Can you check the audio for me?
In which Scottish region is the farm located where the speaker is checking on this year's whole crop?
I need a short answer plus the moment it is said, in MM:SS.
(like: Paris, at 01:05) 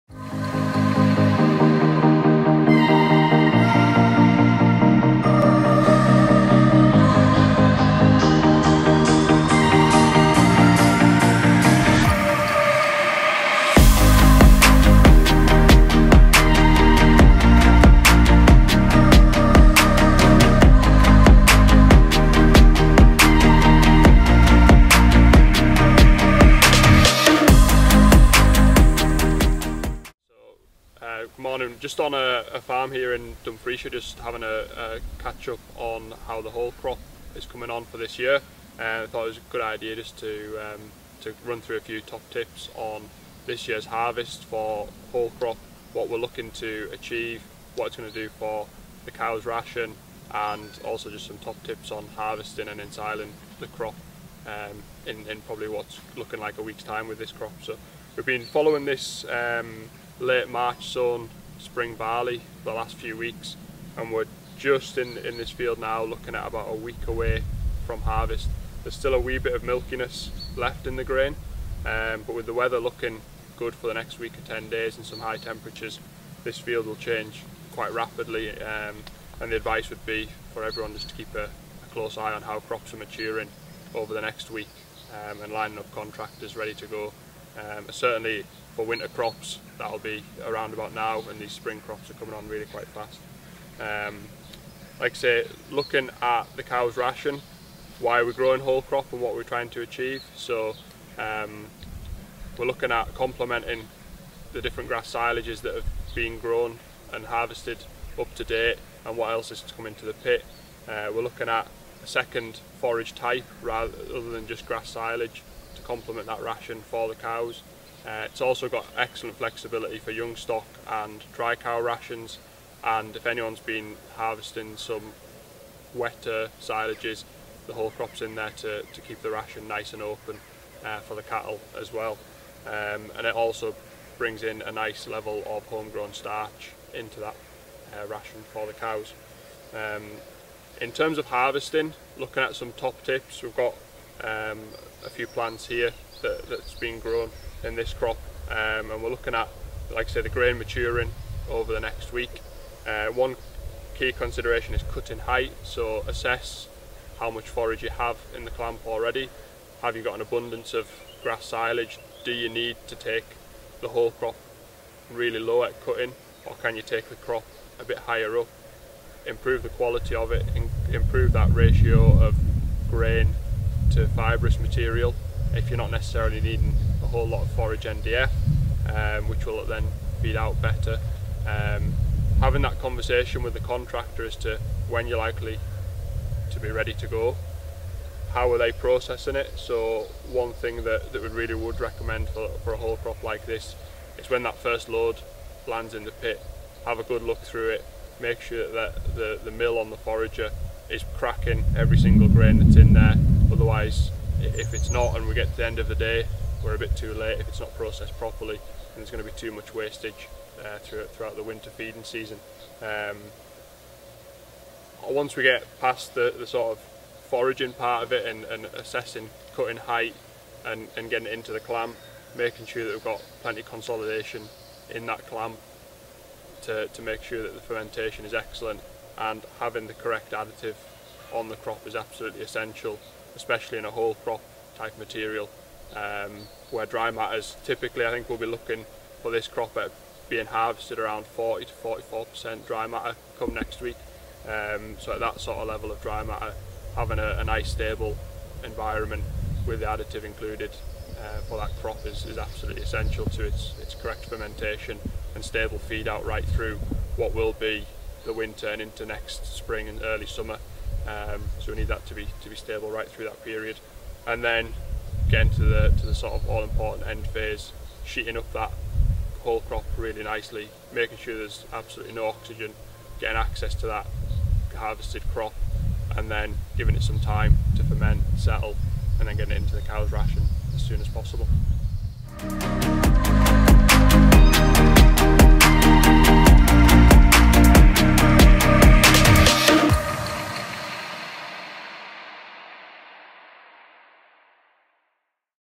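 Dumfriesshire, at 00:33.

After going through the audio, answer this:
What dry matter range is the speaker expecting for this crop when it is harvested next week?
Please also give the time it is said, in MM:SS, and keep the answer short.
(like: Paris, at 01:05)
40 to 44%, at 04:01.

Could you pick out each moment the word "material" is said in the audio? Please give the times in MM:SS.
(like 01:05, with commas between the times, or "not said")
02:54, 03:54.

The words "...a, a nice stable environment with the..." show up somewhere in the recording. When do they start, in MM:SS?
04:07.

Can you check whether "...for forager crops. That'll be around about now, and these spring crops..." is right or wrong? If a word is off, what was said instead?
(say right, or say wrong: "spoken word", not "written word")
wrong: "winter", not "forager".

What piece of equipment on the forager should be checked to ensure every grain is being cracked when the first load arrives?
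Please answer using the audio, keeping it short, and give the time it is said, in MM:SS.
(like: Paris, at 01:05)
The mill, at 03:19.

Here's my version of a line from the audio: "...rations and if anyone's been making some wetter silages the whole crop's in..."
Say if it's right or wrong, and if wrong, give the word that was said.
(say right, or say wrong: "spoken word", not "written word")
wrong: "harvesting", not "making".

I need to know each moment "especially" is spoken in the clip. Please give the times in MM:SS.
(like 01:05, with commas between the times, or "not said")
03:53.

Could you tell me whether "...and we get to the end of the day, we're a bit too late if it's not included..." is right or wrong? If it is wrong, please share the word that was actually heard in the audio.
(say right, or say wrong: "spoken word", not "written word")
wrong: "processed", not "included".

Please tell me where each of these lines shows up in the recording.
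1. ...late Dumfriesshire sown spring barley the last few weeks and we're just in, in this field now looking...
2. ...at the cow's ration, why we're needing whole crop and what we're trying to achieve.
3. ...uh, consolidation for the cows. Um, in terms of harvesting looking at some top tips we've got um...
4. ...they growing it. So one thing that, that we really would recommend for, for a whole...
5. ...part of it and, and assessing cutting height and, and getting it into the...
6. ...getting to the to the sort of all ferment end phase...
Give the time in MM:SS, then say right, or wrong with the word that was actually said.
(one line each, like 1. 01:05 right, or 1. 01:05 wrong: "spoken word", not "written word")
1. 01:00 wrong: "March", not "Dumfriesshire"
2. 01:36 wrong: "growing", not "needing"
3. 02:17 wrong: "ration", not "consolidation"
4. 03:08 wrong: "processing", not "growing"
5. 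03:37 right
6. 04:25 wrong: "important", not "ferment".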